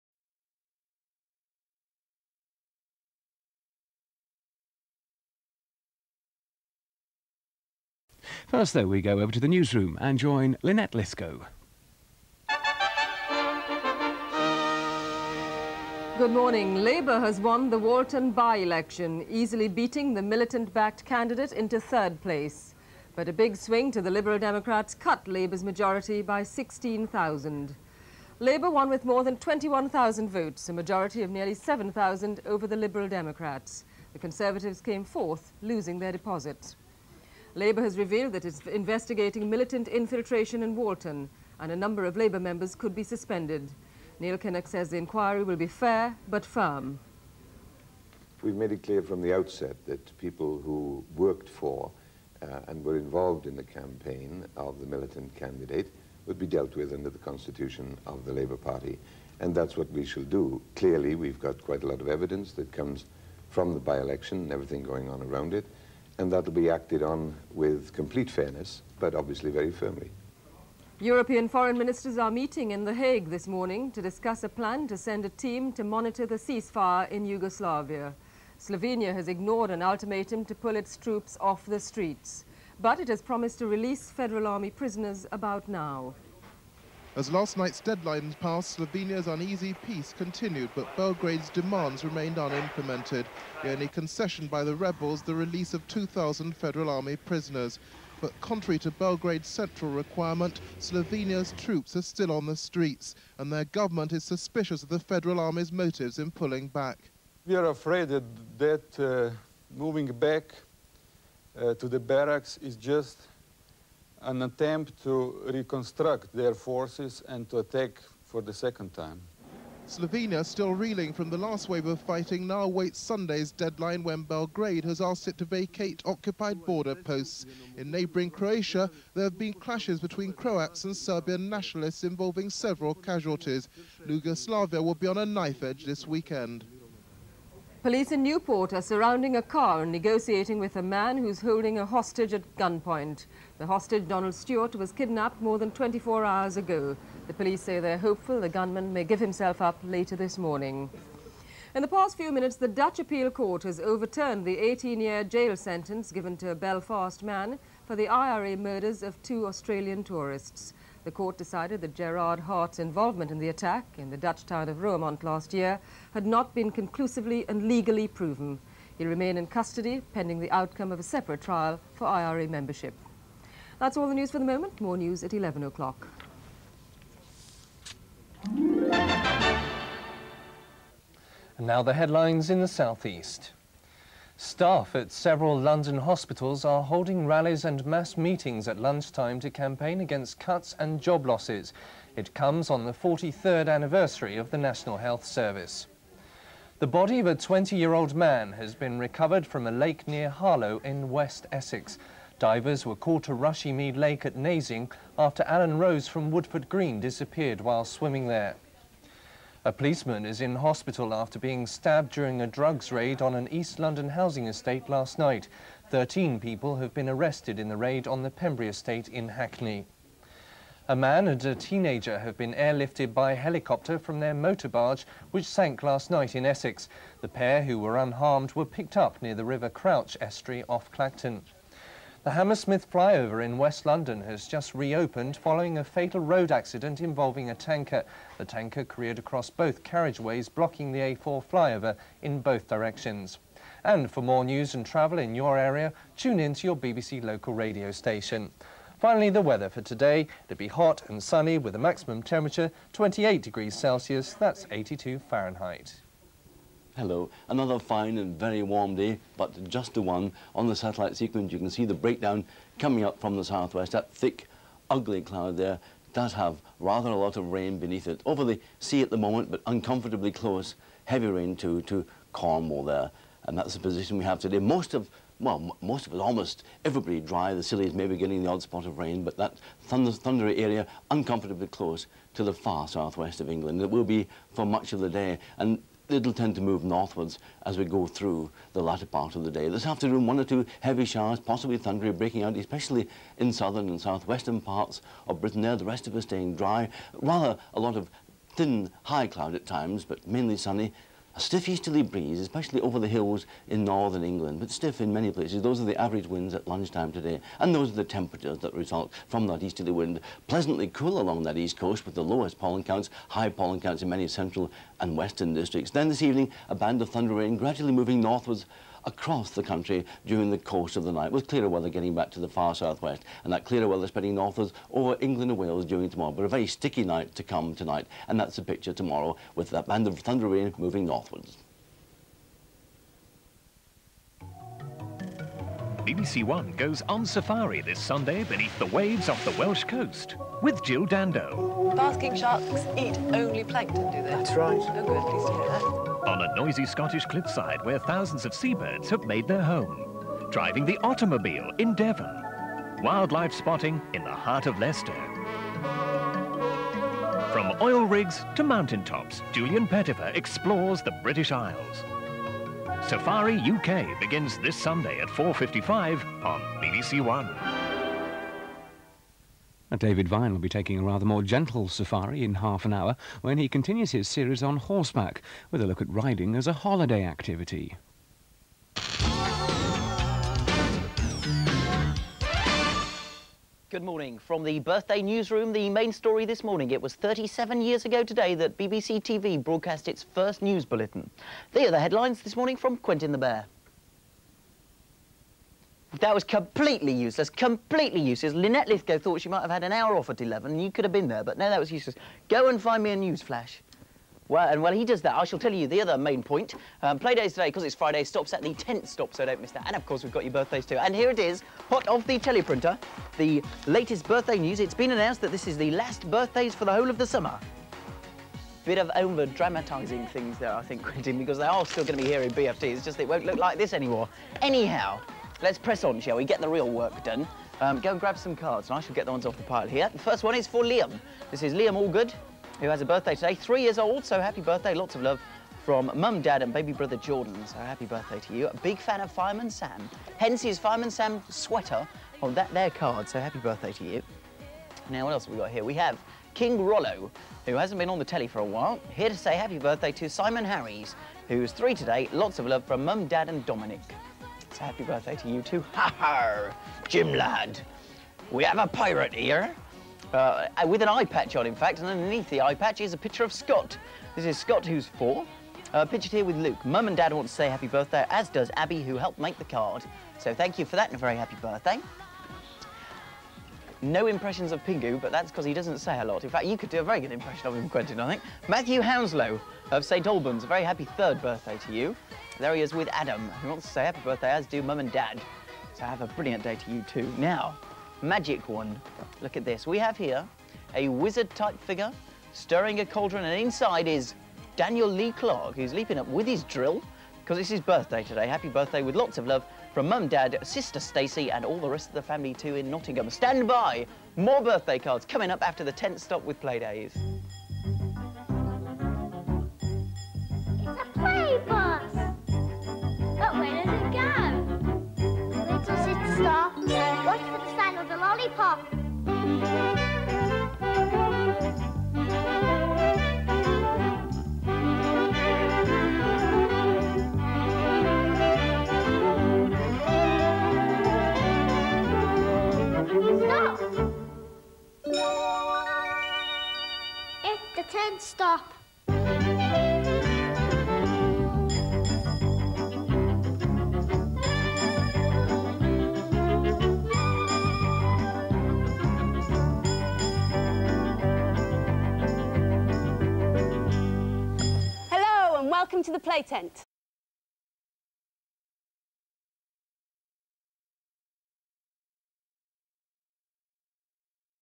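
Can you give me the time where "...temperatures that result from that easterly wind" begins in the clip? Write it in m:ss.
5:08.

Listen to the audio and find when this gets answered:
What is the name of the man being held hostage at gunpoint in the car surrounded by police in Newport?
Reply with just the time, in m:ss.
2:24.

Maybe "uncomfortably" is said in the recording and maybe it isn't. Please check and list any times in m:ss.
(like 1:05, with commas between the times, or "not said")
4:29, 4:41.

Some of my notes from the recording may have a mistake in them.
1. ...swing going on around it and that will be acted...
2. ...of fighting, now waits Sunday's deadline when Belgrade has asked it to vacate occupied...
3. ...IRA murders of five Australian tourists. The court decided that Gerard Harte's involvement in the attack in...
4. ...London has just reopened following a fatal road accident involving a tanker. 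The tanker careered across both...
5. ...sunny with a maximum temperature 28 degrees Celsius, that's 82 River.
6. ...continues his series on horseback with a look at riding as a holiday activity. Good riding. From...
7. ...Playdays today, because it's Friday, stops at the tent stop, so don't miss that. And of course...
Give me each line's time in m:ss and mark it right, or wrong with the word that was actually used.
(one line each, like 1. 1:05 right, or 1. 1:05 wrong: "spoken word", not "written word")
1. 1:04 wrong: "everything", not "swing"
2. 2:01 right
3. 2:38 wrong: "two", not "five"
4. 3:53 right
5. 4:11 wrong: "Fahrenheit", not "River"
6. 6:13 wrong: "morning", not "riding"
7. 6:47 right.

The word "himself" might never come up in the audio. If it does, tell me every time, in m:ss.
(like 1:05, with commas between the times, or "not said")
2:29.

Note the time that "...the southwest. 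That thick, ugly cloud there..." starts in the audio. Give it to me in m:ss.
4:23.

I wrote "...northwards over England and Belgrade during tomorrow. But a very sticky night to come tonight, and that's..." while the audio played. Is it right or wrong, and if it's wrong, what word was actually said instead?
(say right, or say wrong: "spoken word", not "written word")
wrong: "Wales", not "Belgrade".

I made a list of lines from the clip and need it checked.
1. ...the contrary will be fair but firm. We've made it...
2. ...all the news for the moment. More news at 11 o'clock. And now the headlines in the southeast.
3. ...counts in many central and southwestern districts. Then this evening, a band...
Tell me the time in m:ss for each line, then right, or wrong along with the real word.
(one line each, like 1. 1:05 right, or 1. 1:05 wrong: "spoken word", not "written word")
1. 0:44 wrong: "inquiry", not "contrary"
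2. 2:53 right
3. 5:13 wrong: "western", not "southwestern".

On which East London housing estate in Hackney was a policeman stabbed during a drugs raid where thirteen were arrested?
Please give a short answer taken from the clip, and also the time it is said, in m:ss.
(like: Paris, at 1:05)
Pembury estate, at 3:38.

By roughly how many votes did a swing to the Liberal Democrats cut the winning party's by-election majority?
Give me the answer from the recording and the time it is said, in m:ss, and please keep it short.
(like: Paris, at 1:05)
16,000, at 0:26.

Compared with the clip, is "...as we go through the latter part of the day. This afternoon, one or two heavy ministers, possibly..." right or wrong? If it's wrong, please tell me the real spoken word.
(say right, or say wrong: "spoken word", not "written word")
wrong: "showers", not "ministers".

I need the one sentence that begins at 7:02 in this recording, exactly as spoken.
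It's just it won't look like this anymore.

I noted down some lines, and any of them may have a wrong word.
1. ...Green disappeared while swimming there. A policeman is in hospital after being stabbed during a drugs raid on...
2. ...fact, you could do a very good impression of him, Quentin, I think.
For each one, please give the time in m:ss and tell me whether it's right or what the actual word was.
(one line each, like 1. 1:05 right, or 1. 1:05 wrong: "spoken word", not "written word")
1. 3:26 right
2. 7:56 right.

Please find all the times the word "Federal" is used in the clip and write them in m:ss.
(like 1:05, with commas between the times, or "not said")
1:24, 1:36, 1:44.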